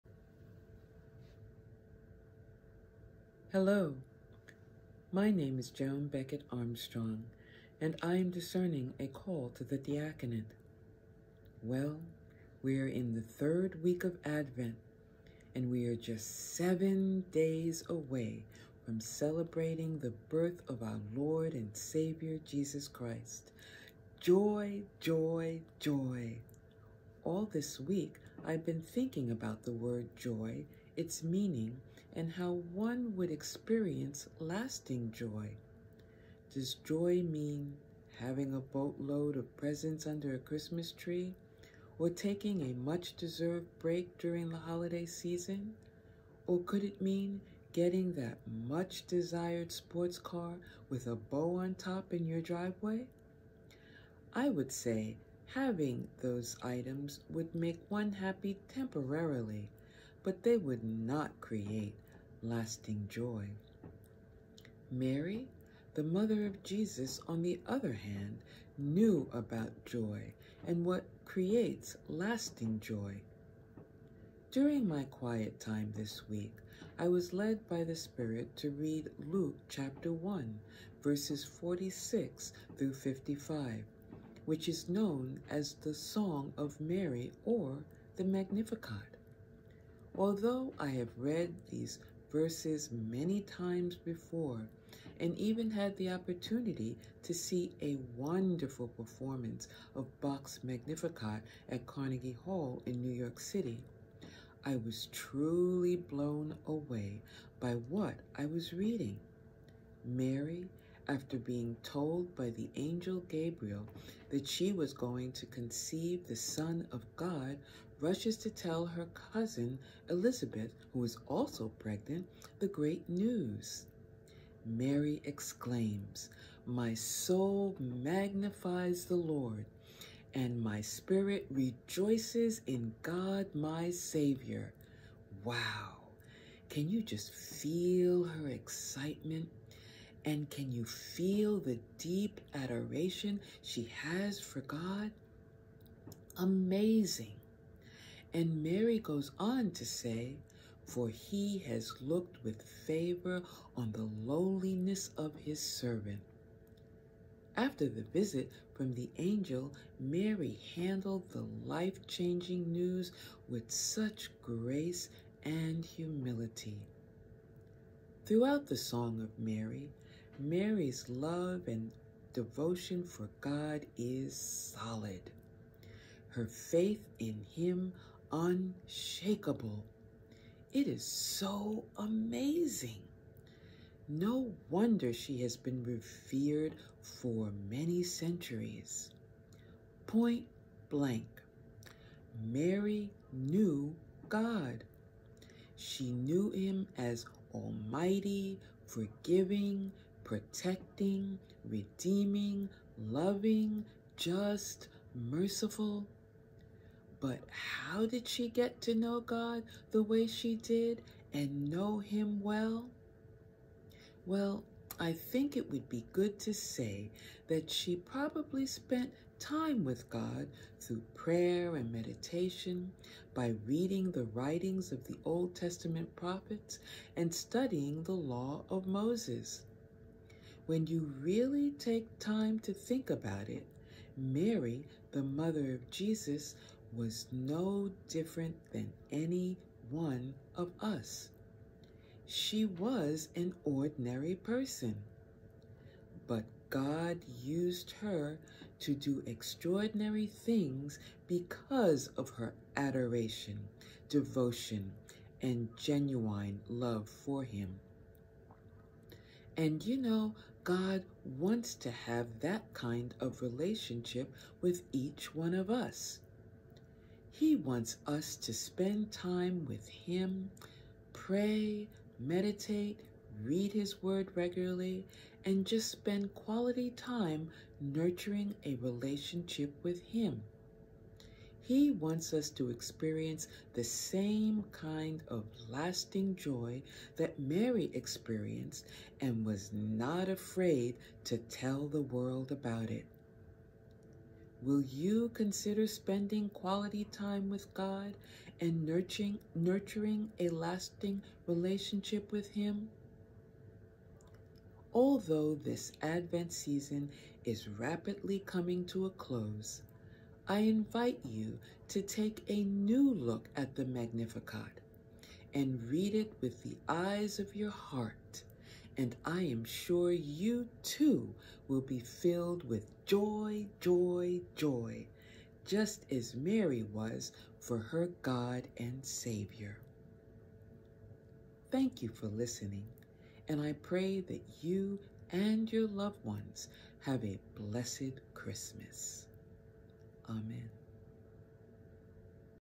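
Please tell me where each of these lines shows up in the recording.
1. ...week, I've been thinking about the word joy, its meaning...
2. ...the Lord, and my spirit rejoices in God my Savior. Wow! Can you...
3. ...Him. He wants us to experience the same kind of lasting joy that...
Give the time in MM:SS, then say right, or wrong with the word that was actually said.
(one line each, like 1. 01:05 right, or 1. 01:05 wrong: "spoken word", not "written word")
1. 00:27 right
2. 02:09 right
3. 04:40 right.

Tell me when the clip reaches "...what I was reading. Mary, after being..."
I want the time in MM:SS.
01:47.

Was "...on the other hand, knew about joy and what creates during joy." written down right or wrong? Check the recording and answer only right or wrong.
wrong.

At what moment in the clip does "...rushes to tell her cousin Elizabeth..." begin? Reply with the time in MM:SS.
01:58.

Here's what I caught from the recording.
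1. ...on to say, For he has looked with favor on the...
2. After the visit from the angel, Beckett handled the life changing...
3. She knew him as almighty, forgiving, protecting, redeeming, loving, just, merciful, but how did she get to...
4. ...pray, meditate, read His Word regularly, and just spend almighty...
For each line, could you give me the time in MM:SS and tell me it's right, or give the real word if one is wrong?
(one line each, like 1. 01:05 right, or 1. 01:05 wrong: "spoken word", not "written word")
1. 02:29 right
2. 02:37 wrong: "Mary", not "Beckett"
3. 03:15 right
4. 04:31 wrong: "quality", not "almighty".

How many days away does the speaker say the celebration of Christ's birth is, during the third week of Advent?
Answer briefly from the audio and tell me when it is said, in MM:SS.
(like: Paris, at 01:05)
7, at 00:16.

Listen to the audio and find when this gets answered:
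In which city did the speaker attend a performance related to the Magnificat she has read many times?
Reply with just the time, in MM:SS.
01:43.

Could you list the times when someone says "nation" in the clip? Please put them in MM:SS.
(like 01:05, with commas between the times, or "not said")
not said.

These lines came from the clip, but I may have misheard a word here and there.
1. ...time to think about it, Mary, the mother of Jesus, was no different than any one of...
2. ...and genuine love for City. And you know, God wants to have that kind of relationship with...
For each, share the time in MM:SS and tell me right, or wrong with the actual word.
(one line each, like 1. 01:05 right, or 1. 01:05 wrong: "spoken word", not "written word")
1. 03:52 right
2. 04:15 wrong: "Him", not "City".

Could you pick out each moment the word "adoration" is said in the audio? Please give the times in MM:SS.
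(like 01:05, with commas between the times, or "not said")
02:22, 04:12.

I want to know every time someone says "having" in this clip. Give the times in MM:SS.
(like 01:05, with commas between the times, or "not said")
00:38, 00:55.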